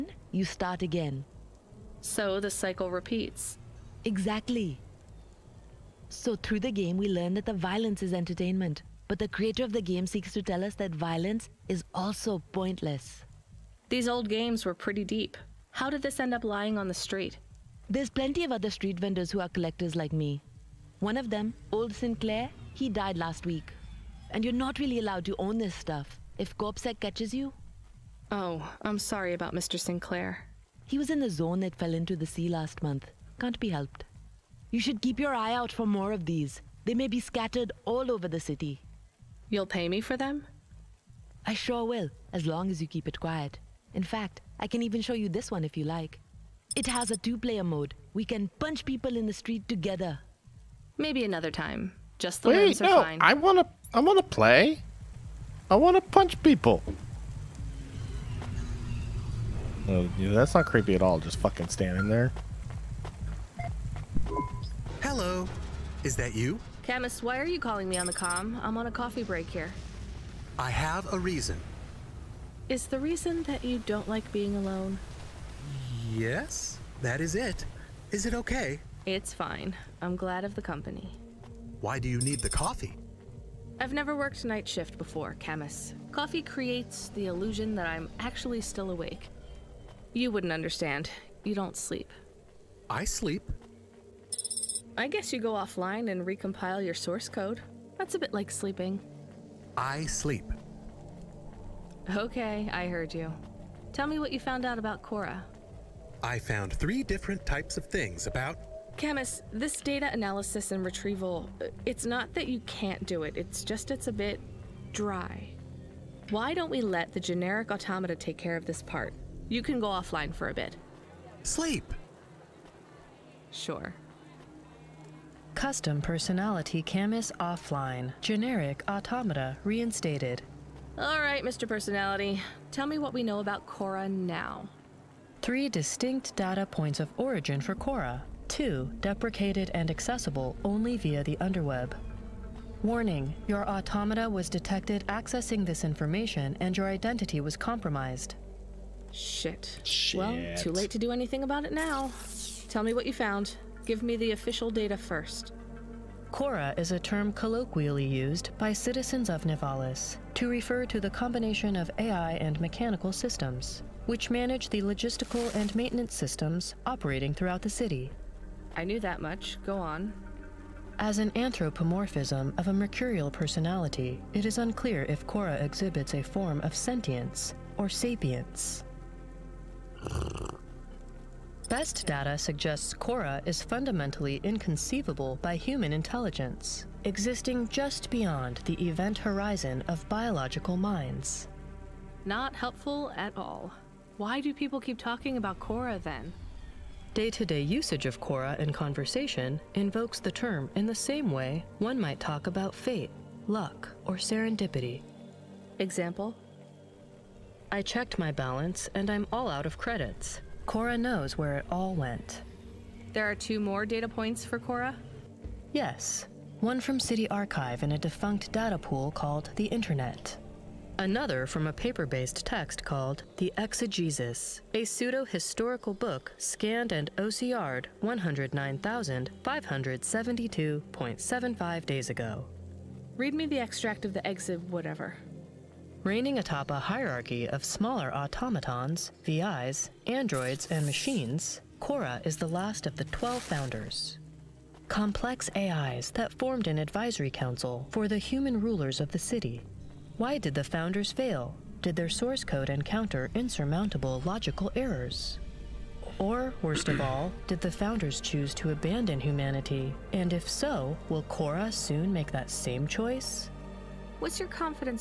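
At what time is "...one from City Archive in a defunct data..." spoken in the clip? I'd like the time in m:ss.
3:36.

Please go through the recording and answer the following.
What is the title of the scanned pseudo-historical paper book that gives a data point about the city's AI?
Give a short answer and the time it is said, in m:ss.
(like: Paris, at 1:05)
The Exegesis, at 3:43.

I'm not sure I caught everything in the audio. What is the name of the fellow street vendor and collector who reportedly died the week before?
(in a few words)
Old Sinclair.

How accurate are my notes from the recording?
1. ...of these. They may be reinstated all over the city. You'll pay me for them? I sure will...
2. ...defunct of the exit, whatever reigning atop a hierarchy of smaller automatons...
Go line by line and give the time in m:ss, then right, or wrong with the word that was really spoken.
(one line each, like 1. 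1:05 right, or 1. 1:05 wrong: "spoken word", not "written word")
1. 0:36 wrong: "scattered", not "reinstated"
2. 3:53 wrong: "extract", not "defunct".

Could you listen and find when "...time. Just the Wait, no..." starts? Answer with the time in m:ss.
0:51.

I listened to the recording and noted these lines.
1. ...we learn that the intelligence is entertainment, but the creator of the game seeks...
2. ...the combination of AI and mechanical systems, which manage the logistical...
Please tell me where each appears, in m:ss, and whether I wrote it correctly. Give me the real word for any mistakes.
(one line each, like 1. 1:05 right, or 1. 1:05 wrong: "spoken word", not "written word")
1. 0:06 wrong: "violence", not "intelligence"
2. 2:40 right.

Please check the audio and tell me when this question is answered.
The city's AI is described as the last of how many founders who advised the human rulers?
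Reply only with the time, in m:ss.
4:03.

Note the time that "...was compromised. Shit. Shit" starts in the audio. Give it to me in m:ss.
2:27.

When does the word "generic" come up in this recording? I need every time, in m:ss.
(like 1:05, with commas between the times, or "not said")
1:57, 2:08.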